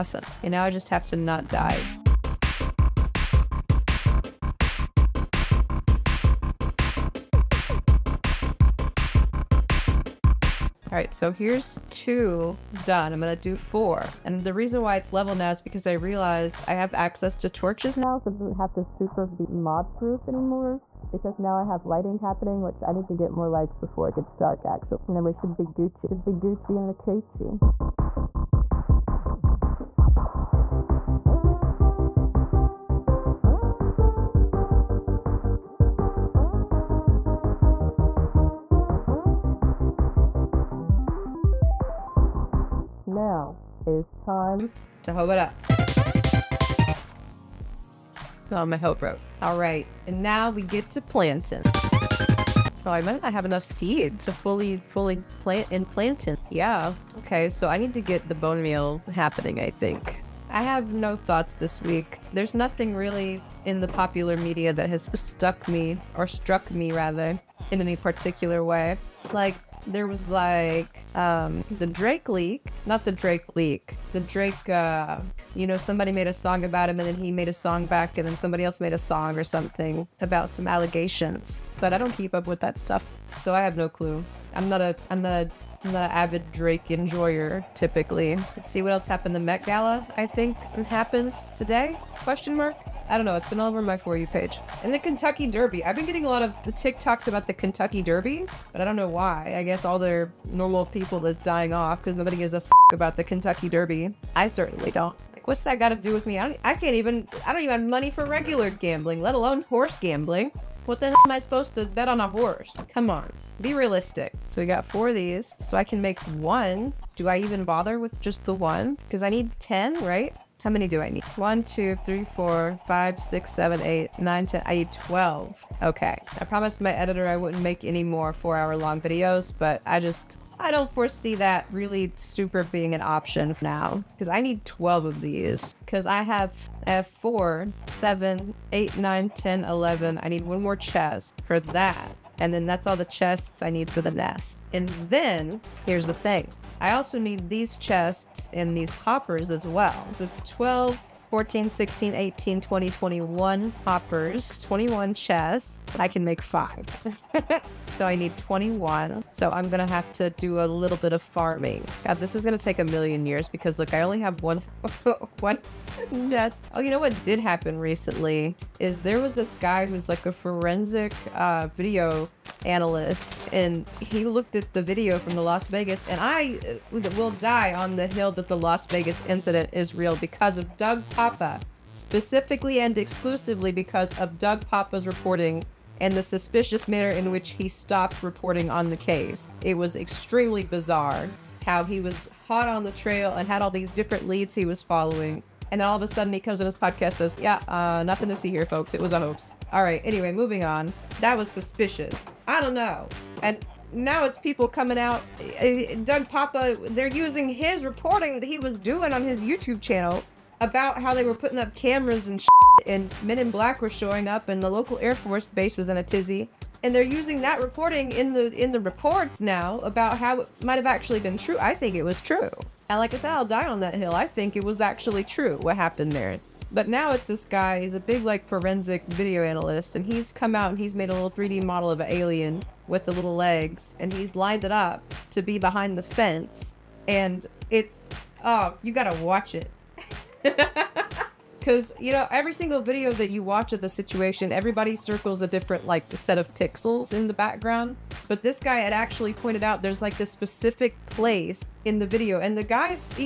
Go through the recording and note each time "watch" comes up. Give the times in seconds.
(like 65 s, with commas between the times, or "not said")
239 s, 243 s.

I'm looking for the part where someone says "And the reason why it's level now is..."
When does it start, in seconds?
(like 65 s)
14 s.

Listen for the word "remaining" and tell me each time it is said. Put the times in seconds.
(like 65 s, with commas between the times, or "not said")
not said.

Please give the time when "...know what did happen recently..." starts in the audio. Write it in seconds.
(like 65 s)
166 s.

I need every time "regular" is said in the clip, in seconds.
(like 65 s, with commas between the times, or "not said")
108 s.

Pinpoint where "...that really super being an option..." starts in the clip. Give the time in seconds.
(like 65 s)
131 s.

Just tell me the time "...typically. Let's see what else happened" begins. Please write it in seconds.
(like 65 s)
87 s.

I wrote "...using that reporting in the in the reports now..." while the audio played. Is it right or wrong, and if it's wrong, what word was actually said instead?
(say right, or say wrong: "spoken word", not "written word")
right.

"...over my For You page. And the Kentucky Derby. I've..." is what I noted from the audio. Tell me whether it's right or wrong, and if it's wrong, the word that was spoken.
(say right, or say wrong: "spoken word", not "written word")
right.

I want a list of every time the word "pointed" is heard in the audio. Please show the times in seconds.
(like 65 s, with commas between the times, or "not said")
249 s.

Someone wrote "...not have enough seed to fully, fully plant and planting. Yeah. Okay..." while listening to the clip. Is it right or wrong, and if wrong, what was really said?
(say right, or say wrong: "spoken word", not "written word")
right.